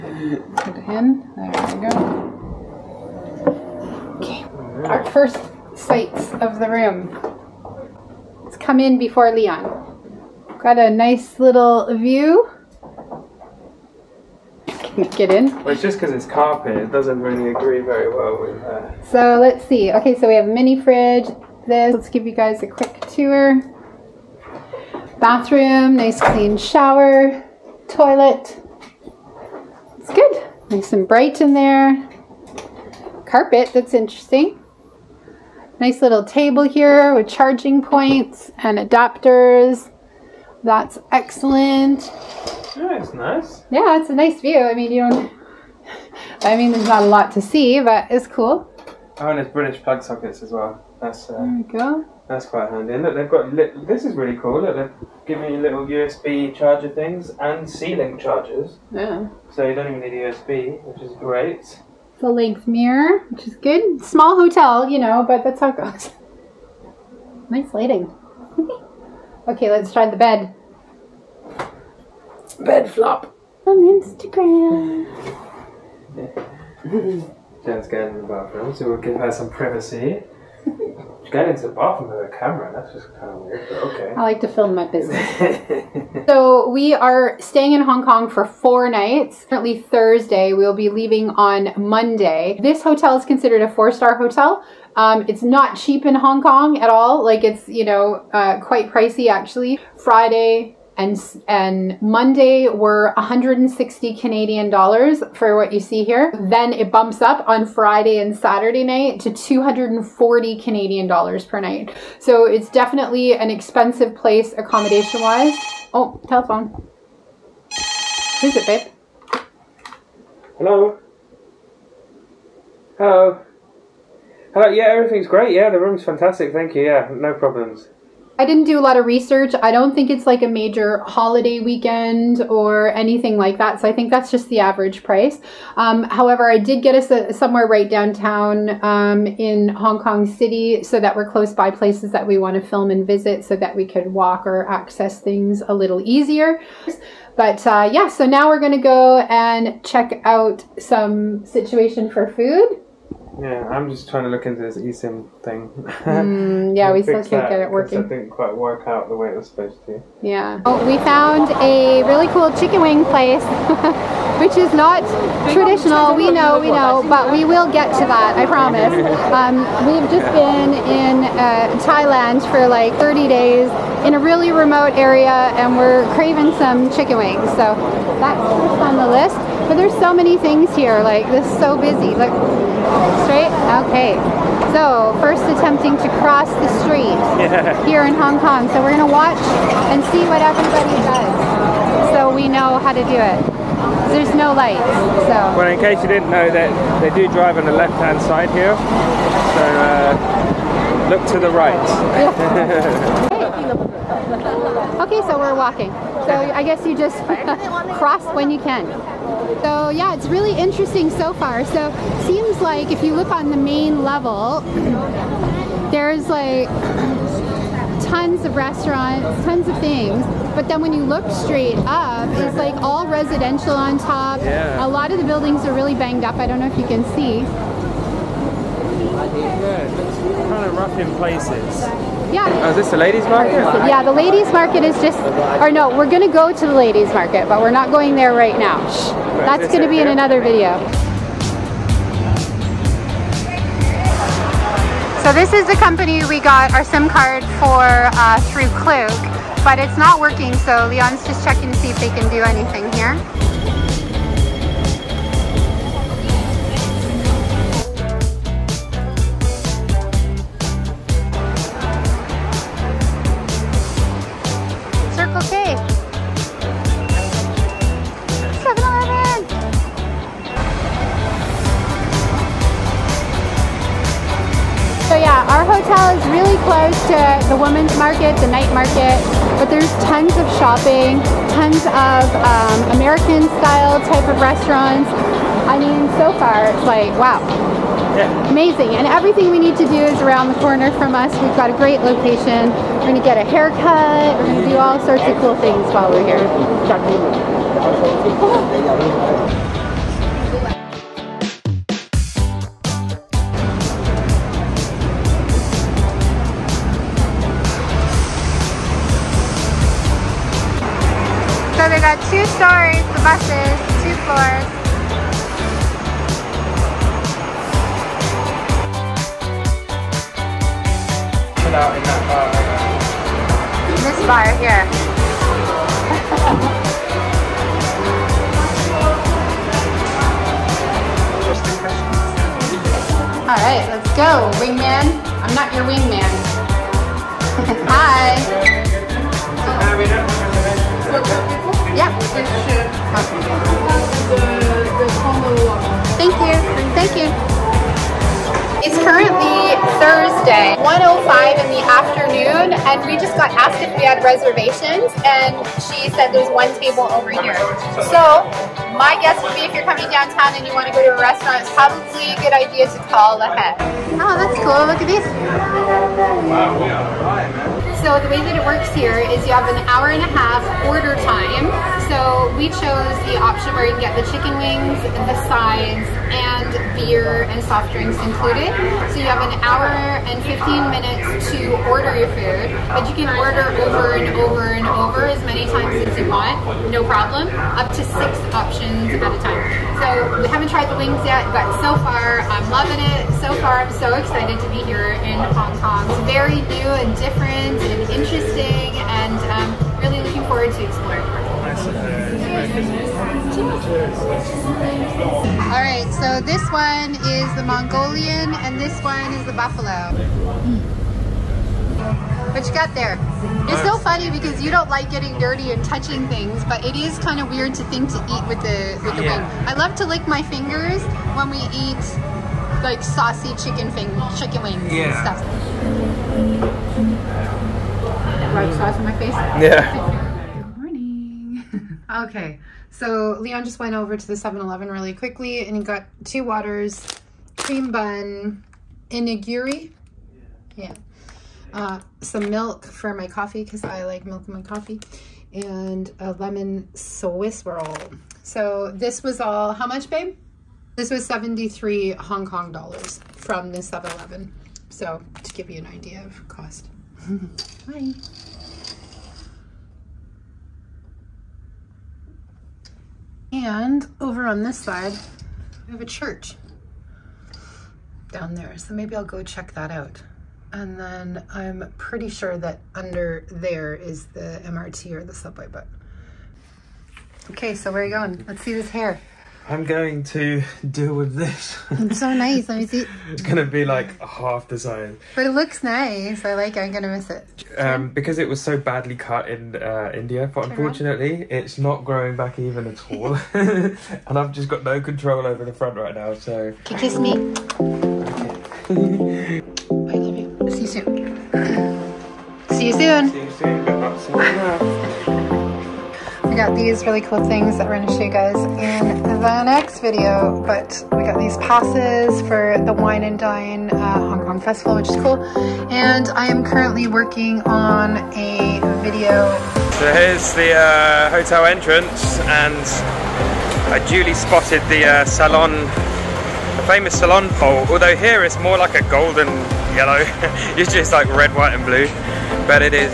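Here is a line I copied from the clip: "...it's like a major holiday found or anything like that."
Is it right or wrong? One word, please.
wrong.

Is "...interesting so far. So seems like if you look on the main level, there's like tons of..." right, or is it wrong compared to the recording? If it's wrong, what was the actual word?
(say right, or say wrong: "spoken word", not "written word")
right.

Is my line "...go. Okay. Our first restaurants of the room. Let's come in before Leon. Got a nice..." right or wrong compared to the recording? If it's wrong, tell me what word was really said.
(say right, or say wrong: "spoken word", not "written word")
wrong: "sights", not "restaurants".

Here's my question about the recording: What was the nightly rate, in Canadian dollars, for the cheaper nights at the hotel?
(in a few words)
160.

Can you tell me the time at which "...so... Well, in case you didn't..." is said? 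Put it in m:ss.
3:15.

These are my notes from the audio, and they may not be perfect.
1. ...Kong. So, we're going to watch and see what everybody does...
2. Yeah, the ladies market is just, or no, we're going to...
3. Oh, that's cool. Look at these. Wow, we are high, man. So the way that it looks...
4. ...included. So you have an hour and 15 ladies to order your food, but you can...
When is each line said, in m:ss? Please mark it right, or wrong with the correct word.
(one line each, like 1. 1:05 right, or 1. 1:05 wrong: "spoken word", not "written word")
1. 3:08 right
2. 3:53 right
3. 6:04 wrong: "works", not "looks"
4. 6:18 wrong: "minutes", not "ladies".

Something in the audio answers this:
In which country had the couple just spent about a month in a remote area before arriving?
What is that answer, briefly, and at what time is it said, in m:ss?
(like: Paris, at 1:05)
Thailand, at 2:51.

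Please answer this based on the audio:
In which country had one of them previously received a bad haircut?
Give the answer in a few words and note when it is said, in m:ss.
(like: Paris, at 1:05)
India, at 8:10.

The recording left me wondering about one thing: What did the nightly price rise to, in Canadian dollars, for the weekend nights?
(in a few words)
240.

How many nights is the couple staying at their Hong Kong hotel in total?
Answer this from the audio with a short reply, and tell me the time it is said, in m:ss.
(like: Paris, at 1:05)
4, at 1:28.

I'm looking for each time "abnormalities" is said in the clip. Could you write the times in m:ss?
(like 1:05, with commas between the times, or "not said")
not said.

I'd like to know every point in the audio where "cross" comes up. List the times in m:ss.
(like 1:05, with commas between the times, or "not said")
3:06, 3:27.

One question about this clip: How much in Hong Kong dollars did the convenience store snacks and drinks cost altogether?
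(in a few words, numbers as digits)
73.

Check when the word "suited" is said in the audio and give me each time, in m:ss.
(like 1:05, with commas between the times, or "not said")
not said.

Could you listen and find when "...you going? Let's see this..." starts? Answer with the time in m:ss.
7:58.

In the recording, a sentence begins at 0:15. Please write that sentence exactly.
Well, it's just because it's carpet.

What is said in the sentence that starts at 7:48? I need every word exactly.
So maybe I'll go check that out.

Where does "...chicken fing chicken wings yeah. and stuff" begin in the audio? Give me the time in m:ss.
7:03.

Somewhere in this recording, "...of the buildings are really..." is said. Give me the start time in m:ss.
3:45.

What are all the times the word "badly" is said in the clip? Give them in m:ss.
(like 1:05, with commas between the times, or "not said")
8:08.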